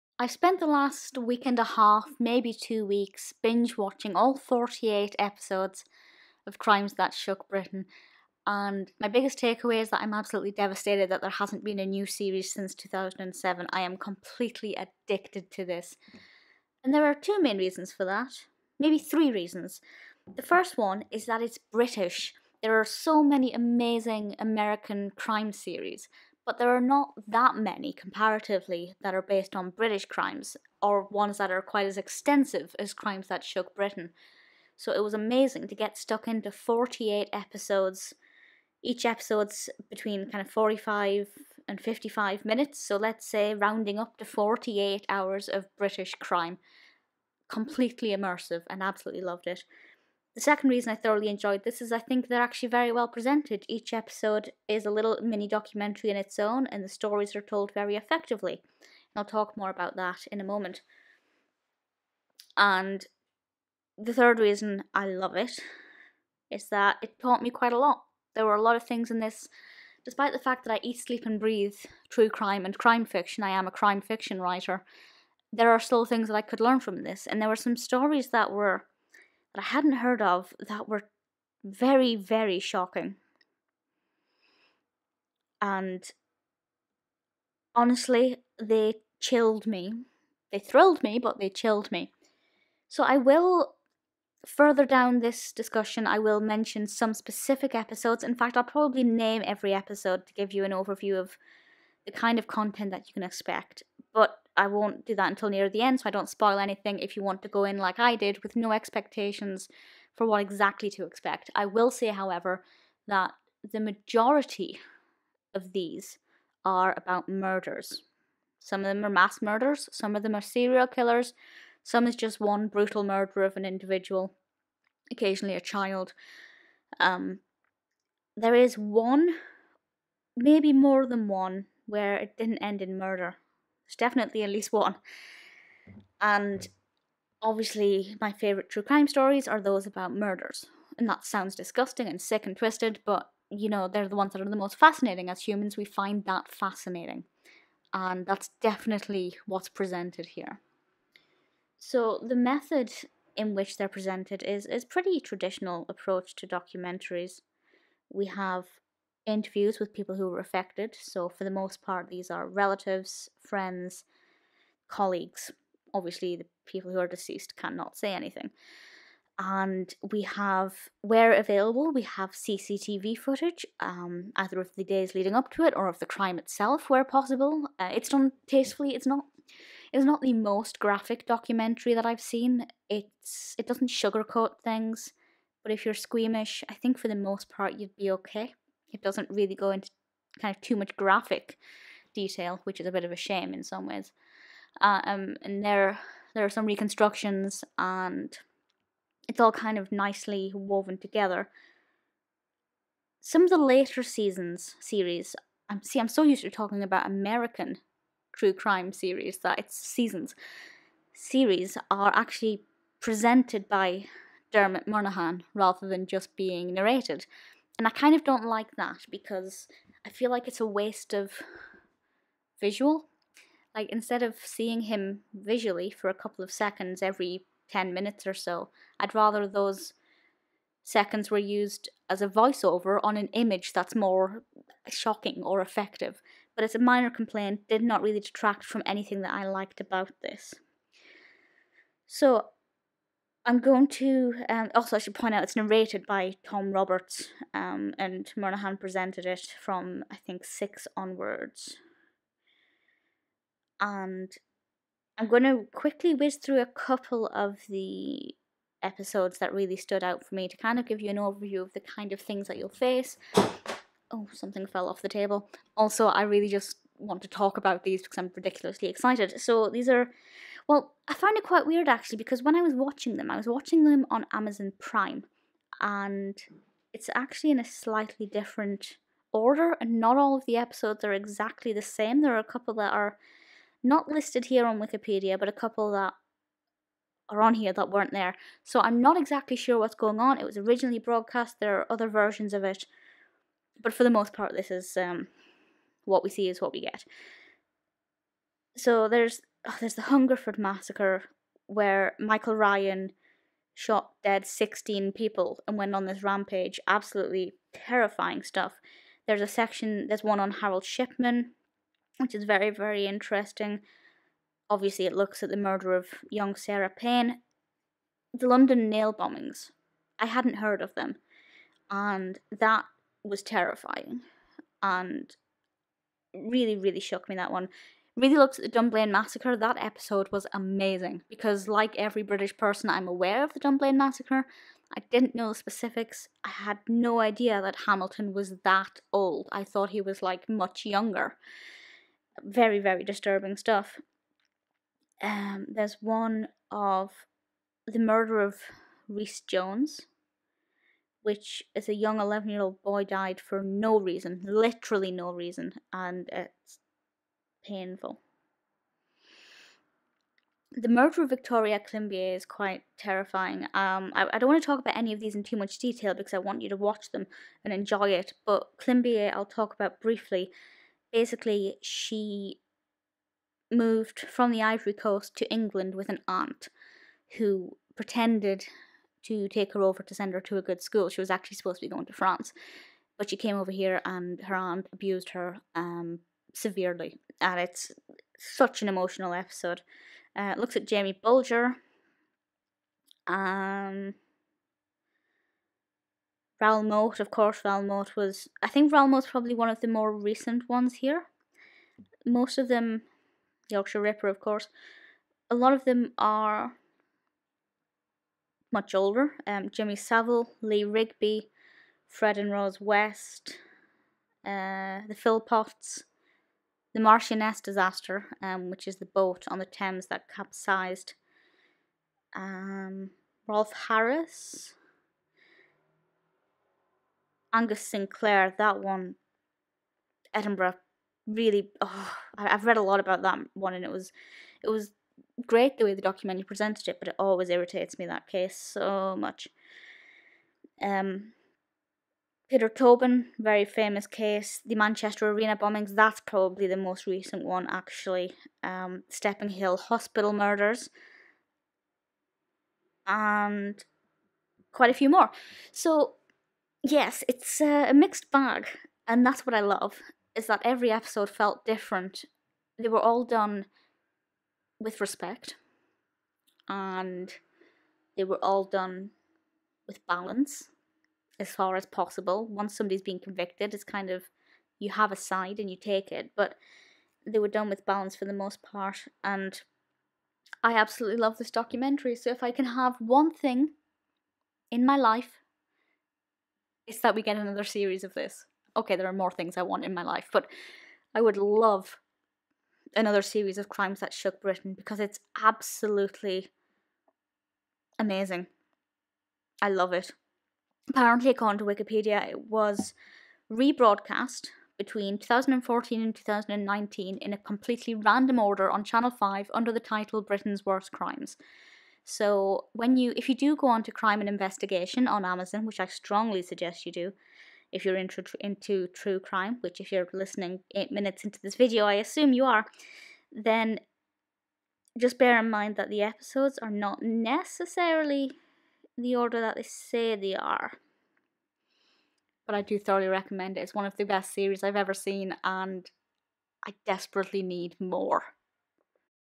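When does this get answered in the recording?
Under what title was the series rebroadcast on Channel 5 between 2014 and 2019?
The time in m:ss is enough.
8:30.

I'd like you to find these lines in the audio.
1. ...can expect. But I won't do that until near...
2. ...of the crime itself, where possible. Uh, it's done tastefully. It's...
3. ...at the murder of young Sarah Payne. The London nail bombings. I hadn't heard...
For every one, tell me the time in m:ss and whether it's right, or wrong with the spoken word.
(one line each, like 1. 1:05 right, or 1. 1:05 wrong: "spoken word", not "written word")
1. 1:43 right
2. 2:55 right
3. 5:15 right.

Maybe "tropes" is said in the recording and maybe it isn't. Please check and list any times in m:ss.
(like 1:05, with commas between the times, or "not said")
not said.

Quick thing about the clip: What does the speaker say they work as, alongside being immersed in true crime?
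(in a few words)
crime fiction writer.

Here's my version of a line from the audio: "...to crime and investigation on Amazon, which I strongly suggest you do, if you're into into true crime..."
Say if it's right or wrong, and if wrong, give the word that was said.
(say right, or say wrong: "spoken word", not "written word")
right.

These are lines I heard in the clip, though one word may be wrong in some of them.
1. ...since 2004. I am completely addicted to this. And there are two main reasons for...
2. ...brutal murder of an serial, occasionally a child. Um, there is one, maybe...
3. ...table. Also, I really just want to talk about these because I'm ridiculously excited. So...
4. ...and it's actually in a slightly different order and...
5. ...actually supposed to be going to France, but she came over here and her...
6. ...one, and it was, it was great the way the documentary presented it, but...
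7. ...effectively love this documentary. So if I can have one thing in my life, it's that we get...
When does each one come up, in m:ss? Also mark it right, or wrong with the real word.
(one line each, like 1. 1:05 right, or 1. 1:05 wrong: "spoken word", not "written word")
1. 0:12 wrong: "2007", not "2004"
2. 2:02 wrong: "individual", not "serial"
3. 4:25 right
4. 4:35 right
5. 6:21 right
6. 7:13 right
7. 8:00 wrong: "absolutely", not "effectively".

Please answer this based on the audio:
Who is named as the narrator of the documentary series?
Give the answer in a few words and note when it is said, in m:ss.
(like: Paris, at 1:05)
Tom Roberts, at 4:06.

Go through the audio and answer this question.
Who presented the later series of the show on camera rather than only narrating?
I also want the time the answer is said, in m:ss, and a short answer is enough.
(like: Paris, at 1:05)
Dermot Murnaghan, at 3:34.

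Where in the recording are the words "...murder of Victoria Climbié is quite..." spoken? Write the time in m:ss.
6:00.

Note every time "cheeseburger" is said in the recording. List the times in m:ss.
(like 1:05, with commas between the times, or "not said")
not said.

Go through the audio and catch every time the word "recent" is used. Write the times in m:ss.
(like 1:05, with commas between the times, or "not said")
6:40, 7:27.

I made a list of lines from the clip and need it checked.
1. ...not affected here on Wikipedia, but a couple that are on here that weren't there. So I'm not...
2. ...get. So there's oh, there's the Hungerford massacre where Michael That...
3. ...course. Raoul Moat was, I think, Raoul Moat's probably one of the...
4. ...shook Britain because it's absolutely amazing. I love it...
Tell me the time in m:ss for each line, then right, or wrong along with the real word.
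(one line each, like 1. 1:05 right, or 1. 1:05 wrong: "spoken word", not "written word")
1. 4:43 wrong: "listed", not "affected"
2. 4:56 wrong: "Ryan", not "That"
3. 6:37 right
4. 8:14 right.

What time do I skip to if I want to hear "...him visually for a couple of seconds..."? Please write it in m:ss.
3:44.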